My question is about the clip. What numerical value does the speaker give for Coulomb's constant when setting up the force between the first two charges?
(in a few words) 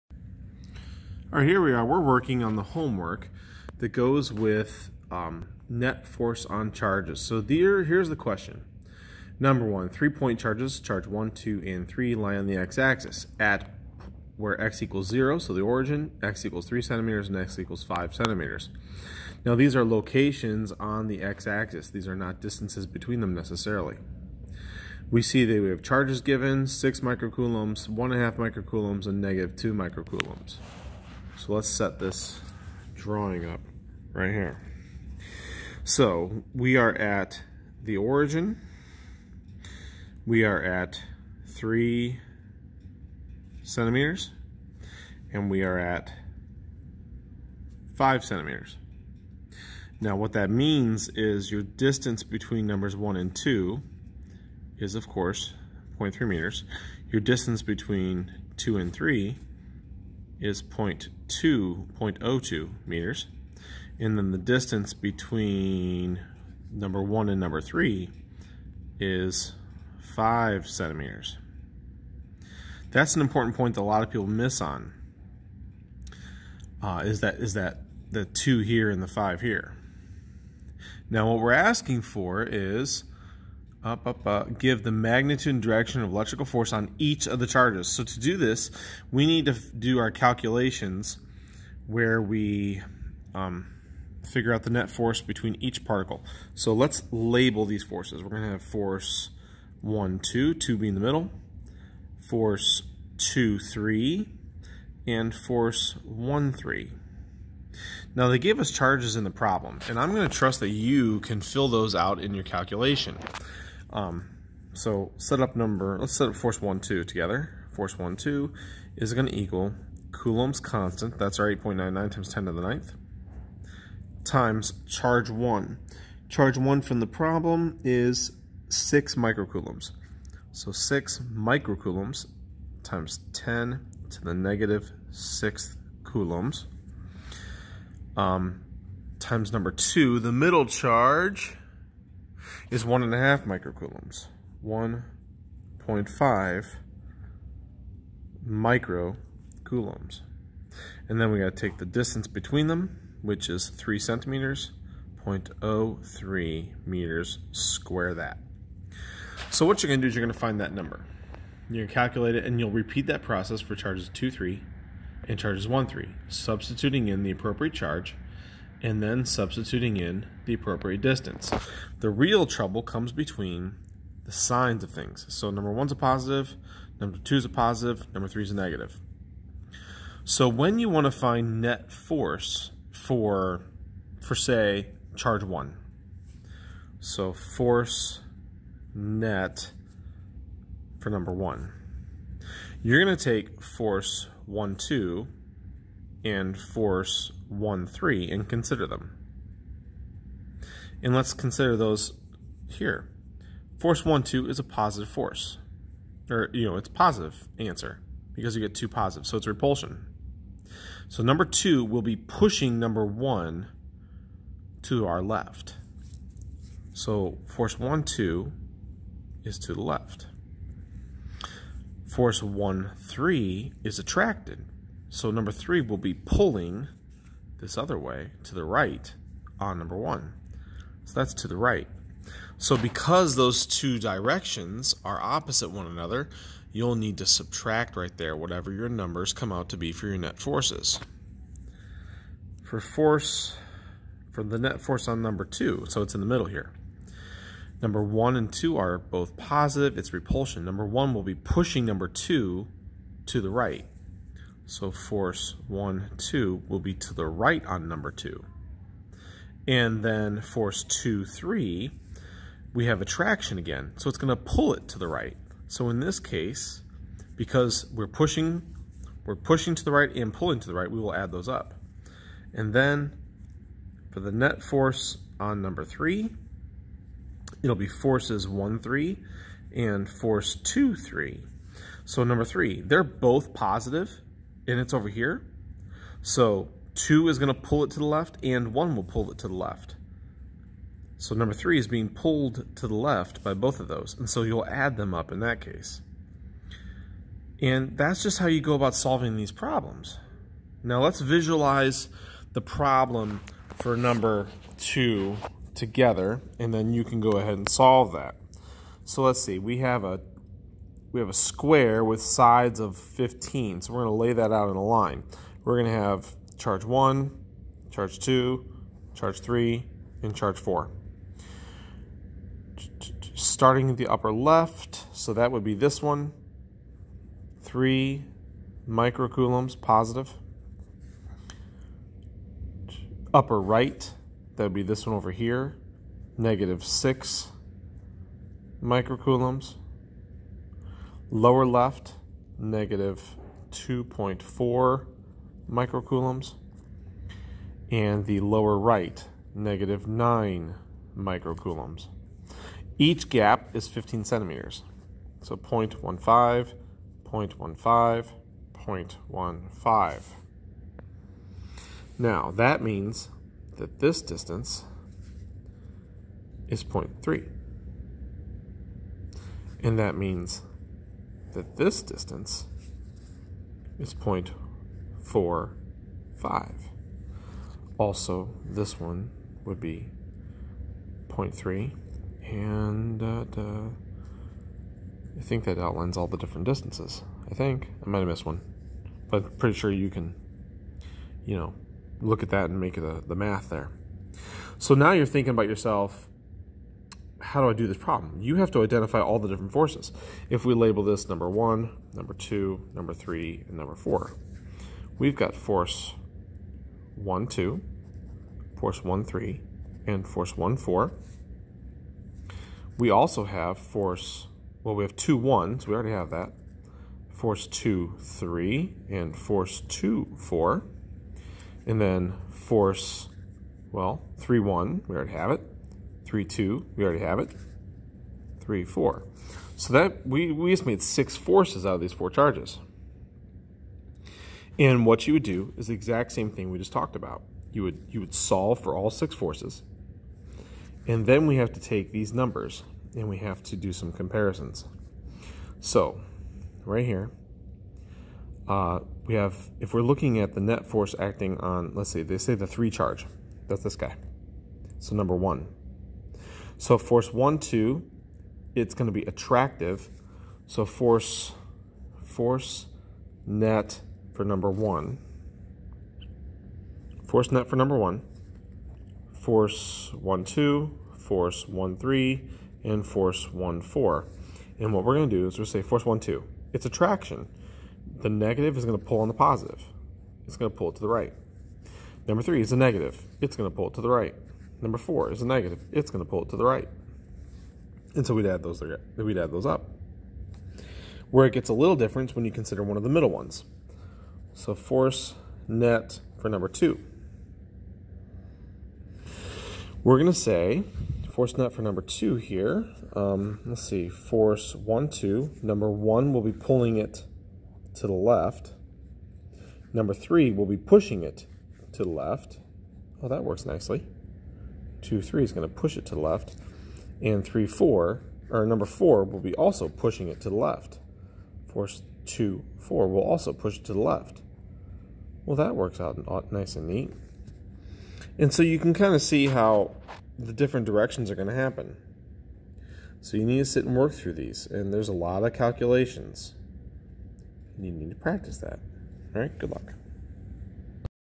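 8.99 times 10^9.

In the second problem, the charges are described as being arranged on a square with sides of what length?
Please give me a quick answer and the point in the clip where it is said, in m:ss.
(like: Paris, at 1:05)
15, at 5:12.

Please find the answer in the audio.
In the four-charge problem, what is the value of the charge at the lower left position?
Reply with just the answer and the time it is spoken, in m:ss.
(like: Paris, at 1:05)
-2.4 microcoulombs, at 5:42.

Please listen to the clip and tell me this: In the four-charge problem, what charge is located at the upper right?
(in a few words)
-6 microcoulombs.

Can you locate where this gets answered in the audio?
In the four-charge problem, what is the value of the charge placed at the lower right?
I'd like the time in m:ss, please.
5:49.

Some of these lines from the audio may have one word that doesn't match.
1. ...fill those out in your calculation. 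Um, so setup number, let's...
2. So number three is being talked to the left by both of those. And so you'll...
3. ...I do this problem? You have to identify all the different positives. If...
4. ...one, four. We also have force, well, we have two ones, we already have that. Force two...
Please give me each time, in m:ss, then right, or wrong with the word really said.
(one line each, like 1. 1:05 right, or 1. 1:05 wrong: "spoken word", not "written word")
1. 1:51 right
2. 4:51 wrong: "pulled", not "talked"
3. 6:37 wrong: "forces", not "positives"
4. 6:50 right.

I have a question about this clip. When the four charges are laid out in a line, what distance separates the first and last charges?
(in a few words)
0.45.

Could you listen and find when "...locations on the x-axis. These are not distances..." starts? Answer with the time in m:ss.
0:19.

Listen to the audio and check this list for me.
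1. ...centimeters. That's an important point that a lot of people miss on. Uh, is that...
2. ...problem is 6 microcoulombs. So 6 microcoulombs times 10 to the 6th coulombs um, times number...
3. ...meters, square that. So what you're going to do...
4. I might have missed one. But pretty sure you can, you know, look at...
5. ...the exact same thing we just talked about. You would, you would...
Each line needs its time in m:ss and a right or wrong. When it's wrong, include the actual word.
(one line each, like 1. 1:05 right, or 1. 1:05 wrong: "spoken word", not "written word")
1. 1:10 right
2. 2:07 right
3. 2:36 right
4. 6:28 right
5. 7:15 right.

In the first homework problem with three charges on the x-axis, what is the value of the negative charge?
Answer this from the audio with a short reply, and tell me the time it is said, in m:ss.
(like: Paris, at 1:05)
-2 microcoulombs, at 0:29.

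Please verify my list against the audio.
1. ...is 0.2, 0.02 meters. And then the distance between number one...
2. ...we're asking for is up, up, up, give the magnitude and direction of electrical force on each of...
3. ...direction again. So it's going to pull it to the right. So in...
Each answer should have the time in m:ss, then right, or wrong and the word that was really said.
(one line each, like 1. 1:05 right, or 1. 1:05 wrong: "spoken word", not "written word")
1. 1:00 right
2. 1:21 right
3. 4:23 wrong: "attraction", not "direction".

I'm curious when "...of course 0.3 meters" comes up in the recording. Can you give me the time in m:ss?
0:54.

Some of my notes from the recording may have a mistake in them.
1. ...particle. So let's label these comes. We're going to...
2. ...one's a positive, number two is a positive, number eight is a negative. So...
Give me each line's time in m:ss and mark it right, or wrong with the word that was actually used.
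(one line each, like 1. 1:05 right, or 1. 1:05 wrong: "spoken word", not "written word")
1. 1:35 wrong: "forces", not "comes"
2. 2:55 wrong: "three", not "eight".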